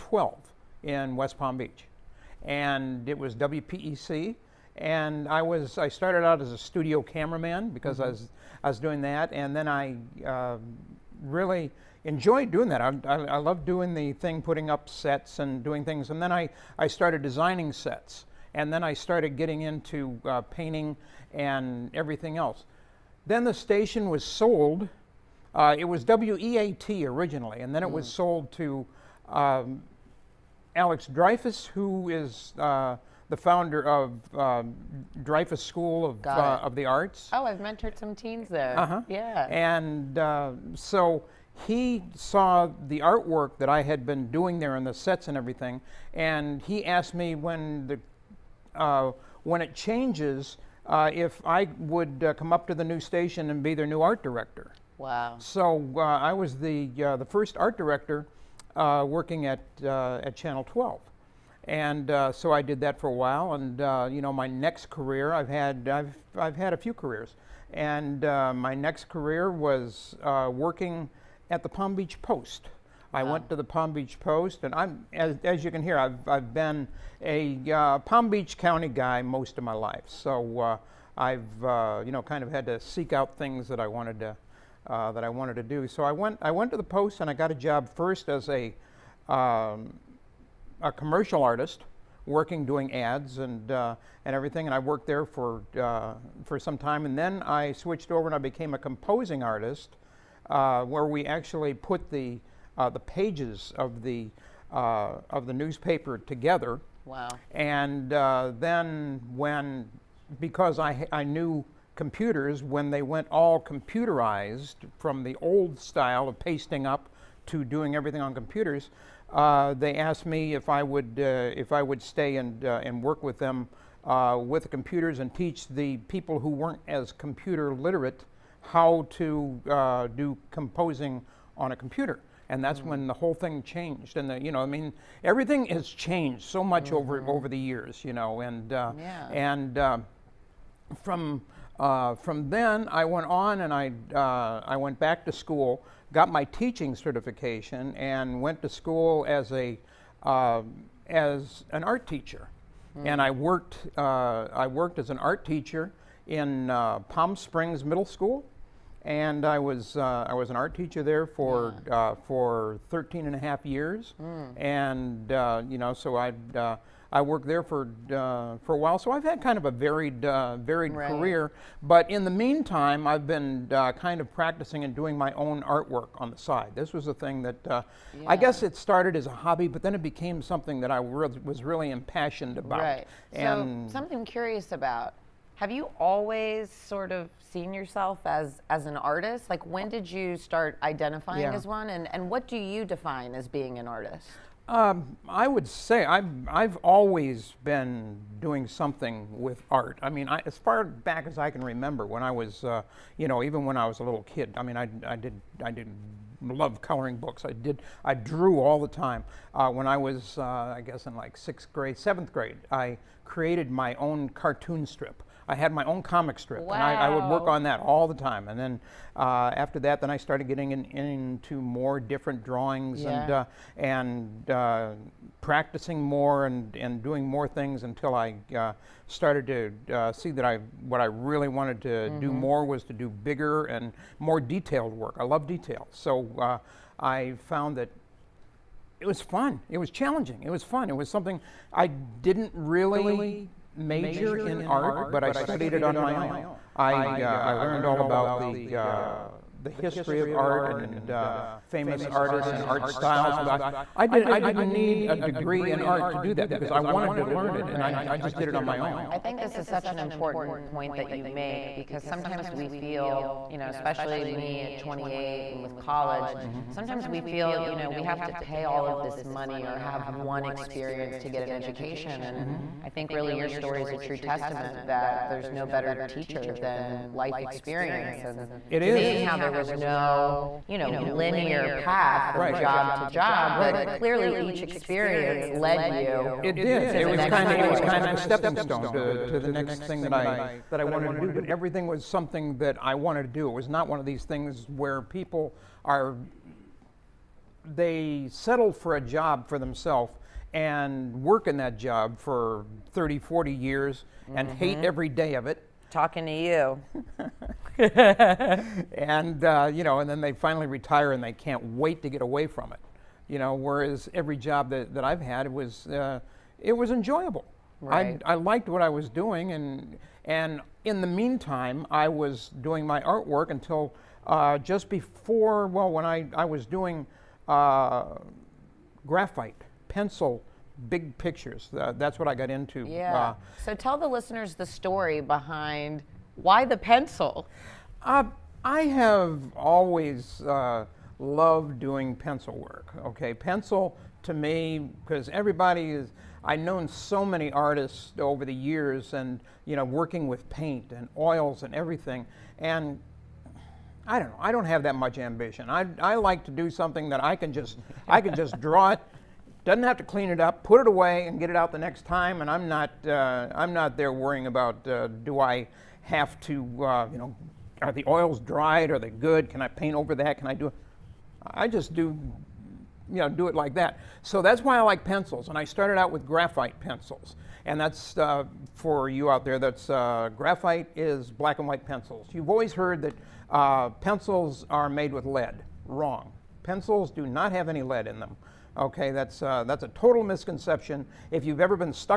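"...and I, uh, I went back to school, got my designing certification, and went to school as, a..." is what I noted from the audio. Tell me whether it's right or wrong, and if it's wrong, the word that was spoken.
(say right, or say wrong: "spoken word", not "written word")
wrong: "teaching", not "designing".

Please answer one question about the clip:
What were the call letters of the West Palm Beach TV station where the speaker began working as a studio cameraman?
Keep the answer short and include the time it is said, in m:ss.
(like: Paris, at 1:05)
WPEC, at 0:03.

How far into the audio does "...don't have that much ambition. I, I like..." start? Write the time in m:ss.
5:54.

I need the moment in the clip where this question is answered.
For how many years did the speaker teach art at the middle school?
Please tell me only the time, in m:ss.
2:42.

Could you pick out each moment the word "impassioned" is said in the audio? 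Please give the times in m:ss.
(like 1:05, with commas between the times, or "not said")
3:01.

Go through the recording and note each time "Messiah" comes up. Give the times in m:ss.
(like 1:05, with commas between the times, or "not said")
not said.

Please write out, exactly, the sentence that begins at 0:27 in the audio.
was sold to um, Alex Dreyfoos, who is uh, the founder of um, Dreyfoos School of, uh, of the Arts.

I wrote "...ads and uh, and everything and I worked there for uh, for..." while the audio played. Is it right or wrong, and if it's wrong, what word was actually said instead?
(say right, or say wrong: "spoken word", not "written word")
right.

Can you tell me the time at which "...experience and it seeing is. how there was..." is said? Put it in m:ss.
4:37.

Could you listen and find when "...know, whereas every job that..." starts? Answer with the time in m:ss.
5:13.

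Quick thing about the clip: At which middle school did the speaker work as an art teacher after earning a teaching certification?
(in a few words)
Palm Springs Middle School.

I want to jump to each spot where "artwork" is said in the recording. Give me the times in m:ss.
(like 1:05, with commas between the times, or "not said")
0:42, 2:55, 5:23.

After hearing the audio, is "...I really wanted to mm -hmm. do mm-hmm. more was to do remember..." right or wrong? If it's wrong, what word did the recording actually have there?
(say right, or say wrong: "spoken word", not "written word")
wrong: "bigger", not "remember".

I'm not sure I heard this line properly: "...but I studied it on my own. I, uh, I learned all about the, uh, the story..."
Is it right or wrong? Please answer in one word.
wrong.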